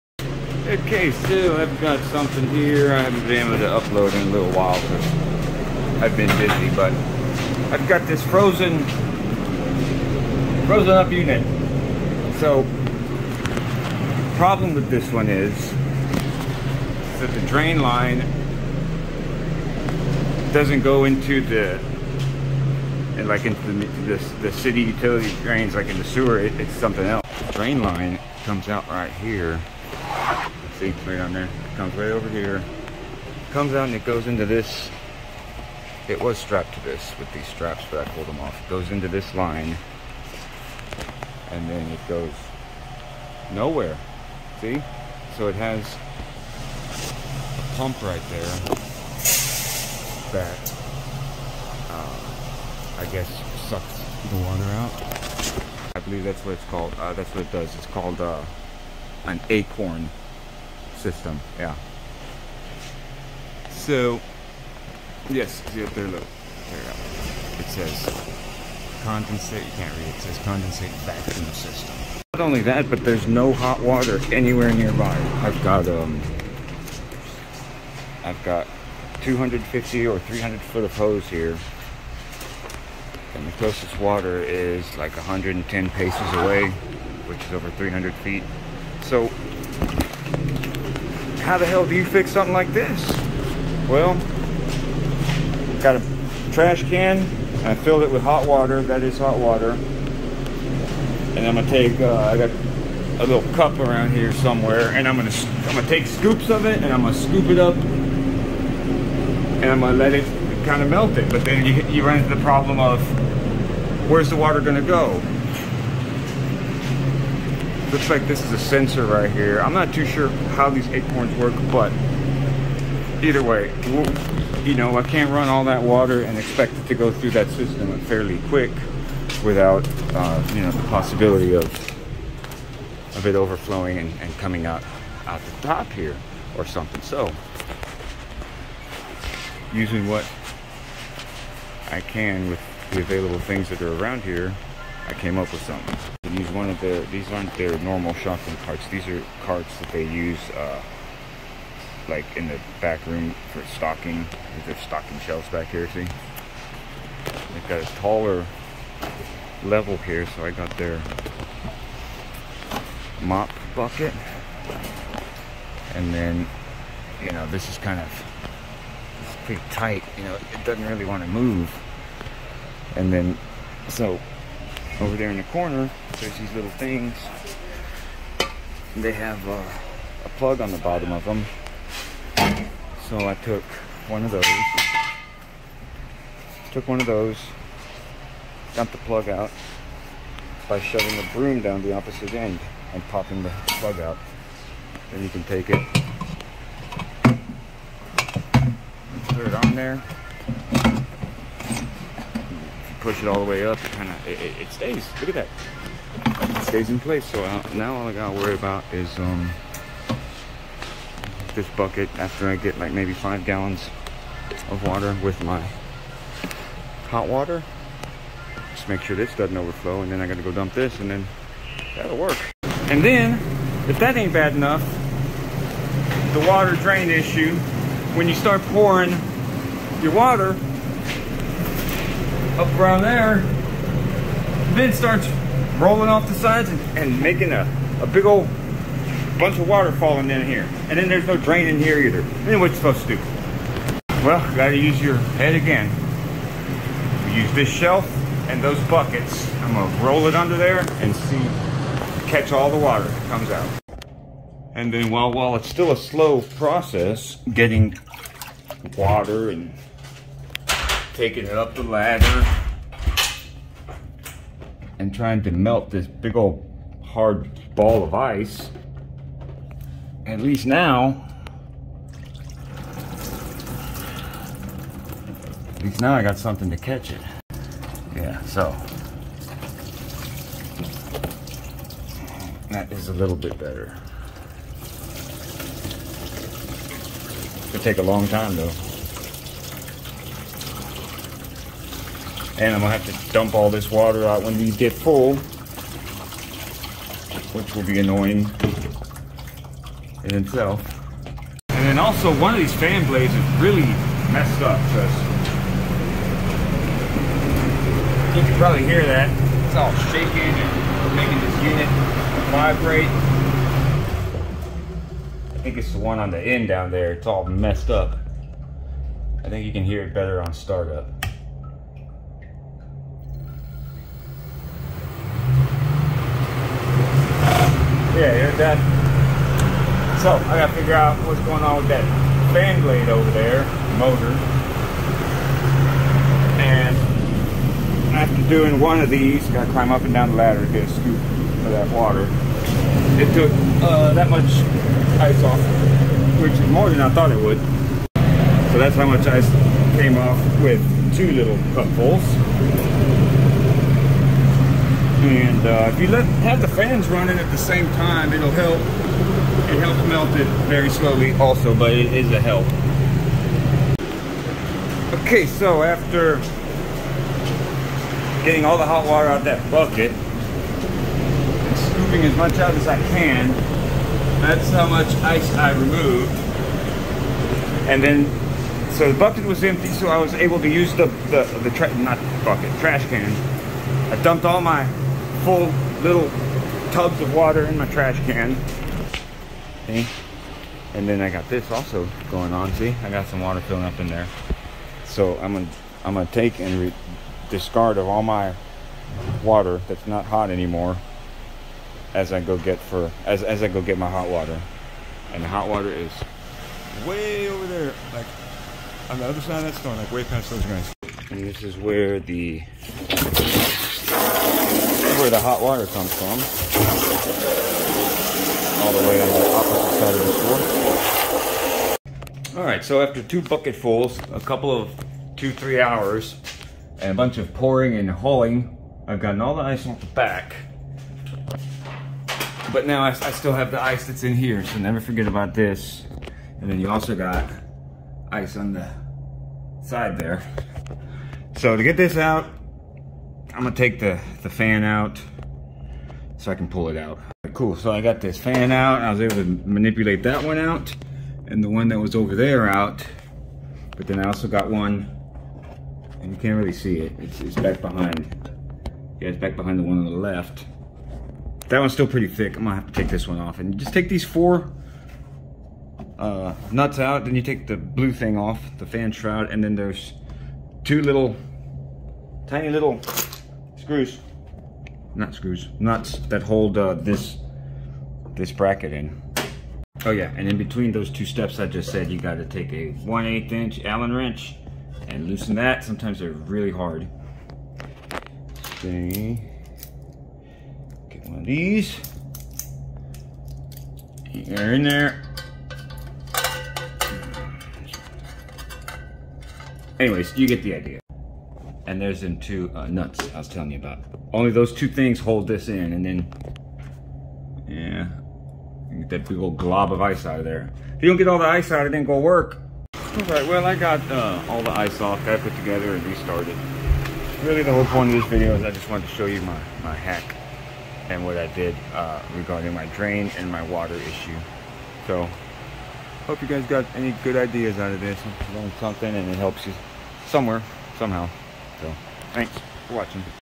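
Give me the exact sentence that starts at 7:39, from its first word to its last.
Yeah, it's back behind the one on the left.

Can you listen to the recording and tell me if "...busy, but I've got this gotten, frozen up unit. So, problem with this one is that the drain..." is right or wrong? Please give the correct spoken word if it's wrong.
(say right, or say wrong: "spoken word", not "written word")
wrong: "frozen", not "gotten".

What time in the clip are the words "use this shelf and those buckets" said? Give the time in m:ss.
4:07.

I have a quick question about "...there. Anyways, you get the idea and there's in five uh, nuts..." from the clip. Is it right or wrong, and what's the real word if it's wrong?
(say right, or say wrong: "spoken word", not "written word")
wrong: "two", not "five".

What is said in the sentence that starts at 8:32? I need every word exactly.
All right, well, I got uh, all the ice off, I put together and restarted.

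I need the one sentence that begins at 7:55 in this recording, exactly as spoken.
Not screws, nuts that hold uh, this this bracket in.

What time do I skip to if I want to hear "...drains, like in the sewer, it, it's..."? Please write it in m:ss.
0:25.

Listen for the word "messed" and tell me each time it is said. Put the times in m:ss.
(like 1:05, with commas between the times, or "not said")
5:04, 5:17.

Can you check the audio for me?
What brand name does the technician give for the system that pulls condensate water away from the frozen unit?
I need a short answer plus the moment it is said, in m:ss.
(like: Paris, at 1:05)
Acorn, at 0:59.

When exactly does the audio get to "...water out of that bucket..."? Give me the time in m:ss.
6:09.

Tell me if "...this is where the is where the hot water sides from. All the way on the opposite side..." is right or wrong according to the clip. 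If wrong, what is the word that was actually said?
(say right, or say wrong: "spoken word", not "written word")
wrong: "comes", not "sides".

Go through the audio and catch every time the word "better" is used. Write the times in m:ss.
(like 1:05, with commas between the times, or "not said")
4:43, 5:20.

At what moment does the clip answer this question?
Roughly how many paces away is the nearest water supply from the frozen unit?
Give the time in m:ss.
1:25.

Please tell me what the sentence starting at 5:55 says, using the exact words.
And uh, if you let have the fans running at the same time, it'll help.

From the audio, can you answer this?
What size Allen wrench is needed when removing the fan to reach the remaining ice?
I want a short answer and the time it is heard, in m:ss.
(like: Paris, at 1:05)
1/8 inch, at 8:02.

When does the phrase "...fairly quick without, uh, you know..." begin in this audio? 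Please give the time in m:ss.
2:08.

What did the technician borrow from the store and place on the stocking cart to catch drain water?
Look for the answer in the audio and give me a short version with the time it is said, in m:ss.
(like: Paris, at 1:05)
Mop bucket, at 2:43.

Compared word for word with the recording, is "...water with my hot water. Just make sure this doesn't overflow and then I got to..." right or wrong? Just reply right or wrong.
right.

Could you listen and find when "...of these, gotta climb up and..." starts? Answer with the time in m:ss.
5:39.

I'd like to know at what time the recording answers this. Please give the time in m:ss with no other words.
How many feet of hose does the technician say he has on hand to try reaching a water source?
1:19.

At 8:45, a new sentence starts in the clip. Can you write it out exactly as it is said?
So, hope you guys got any good ideas out of this, learned something and it helps you somewhere, somehow.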